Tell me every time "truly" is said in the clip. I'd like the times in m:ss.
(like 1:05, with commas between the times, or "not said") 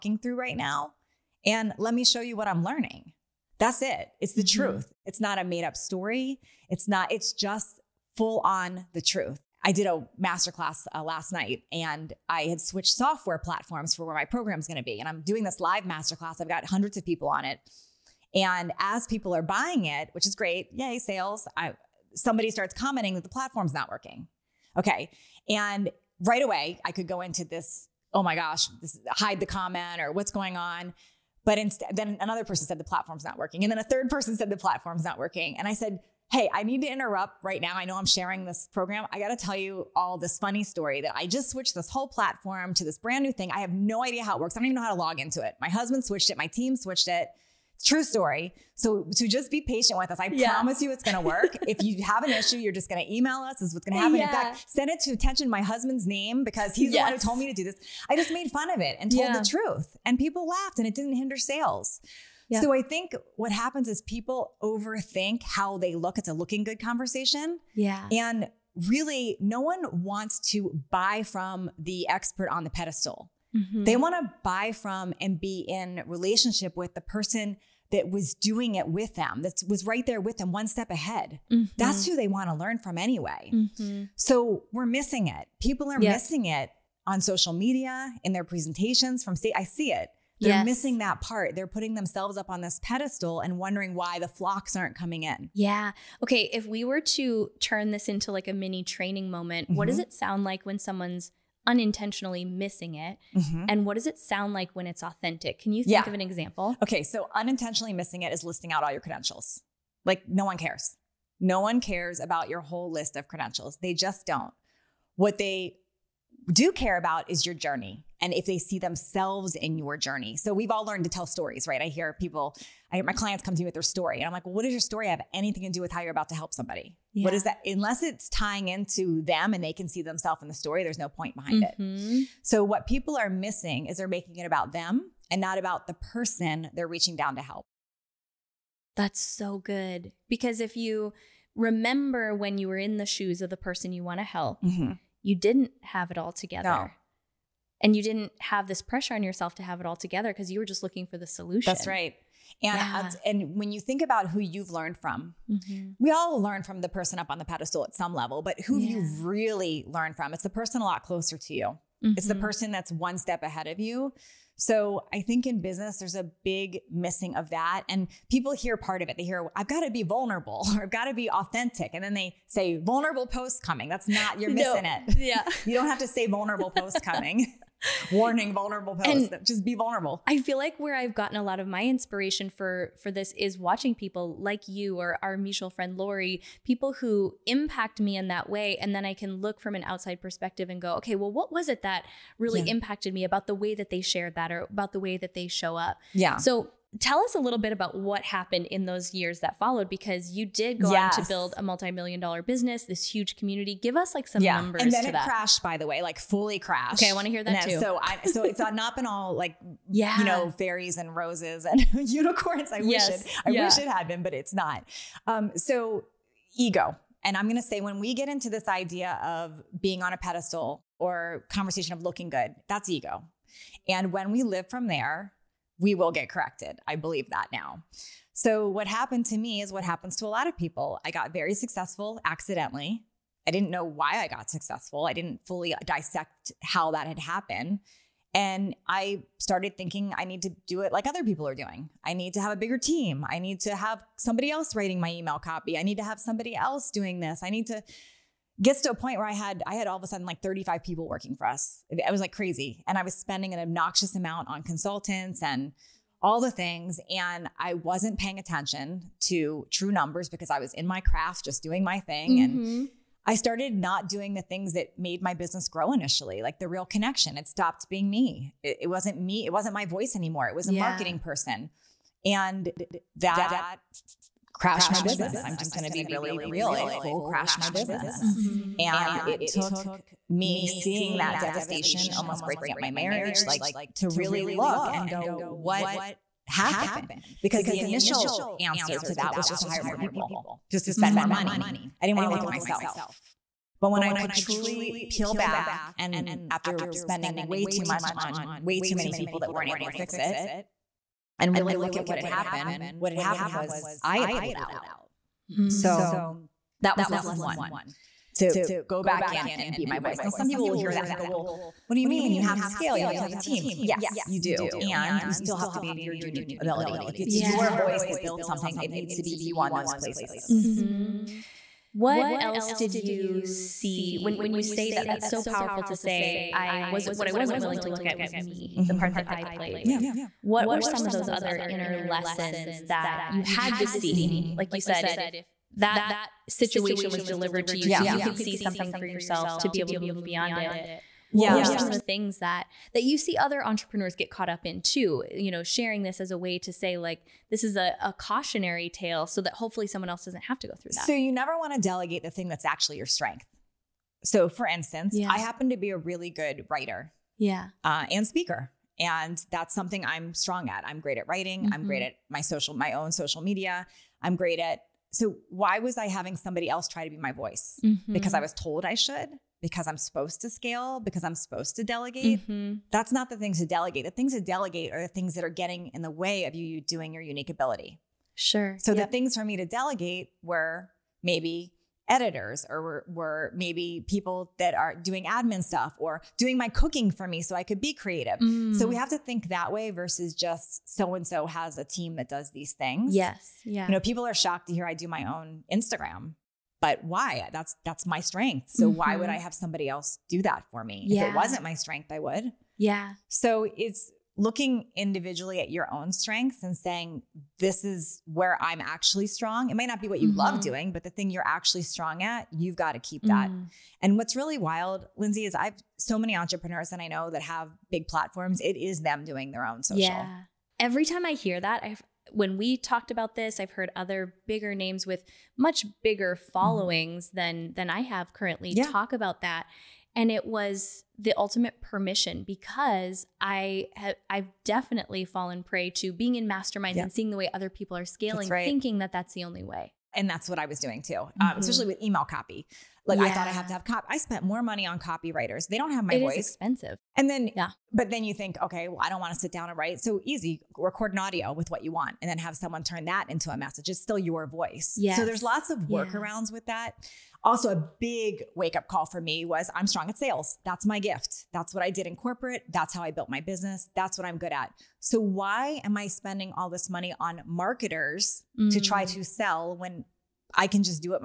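4:54.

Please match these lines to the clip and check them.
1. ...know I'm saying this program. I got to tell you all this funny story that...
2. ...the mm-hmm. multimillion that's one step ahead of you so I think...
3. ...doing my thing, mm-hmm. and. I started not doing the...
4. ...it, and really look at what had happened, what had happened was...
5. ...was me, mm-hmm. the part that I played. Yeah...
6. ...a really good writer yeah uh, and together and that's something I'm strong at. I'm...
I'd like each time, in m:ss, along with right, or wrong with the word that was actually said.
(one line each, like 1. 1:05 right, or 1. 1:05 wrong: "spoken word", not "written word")
1. 0:37 wrong: "sharing", not "saying"
2. 2:42 wrong: "person", not "multimillion"
3. 4:21 right
4. 5:00 right
5. 5:28 right
6. 5:55 wrong: "speaker", not "together".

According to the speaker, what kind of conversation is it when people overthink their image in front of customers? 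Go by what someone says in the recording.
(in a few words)
a looking good conversation.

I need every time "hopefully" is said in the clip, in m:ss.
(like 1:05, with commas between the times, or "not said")
5:49.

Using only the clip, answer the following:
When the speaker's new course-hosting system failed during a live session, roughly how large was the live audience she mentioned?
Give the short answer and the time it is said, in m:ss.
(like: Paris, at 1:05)
hundreds of people, at 0:16.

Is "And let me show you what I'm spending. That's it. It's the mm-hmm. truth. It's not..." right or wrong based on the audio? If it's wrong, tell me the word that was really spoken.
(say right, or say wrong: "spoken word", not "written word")
wrong: "learning", not "spending".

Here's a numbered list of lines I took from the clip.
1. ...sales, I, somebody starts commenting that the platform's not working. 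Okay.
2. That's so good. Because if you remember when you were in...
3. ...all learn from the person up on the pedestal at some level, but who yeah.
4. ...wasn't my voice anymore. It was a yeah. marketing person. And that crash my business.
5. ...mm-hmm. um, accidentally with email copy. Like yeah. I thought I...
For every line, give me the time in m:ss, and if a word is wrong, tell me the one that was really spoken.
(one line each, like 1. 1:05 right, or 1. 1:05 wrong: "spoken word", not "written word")
1. 0:20 right
2. 2:18 right
3. 2:36 right
4. 4:29 right
5. 7:21 wrong: "especially", not "accidentally".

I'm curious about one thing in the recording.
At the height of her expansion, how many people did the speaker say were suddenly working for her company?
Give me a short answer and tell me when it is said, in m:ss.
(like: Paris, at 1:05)
35, at 4:10.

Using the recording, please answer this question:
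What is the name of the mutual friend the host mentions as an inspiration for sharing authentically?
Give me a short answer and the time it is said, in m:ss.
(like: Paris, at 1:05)
Lori, at 3:05.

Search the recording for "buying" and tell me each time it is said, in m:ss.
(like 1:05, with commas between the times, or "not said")
0:19.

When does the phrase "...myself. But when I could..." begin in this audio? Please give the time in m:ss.
4:52.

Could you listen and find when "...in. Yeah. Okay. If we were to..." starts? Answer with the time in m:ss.
1:35.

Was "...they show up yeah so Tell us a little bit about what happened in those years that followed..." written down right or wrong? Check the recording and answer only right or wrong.
right.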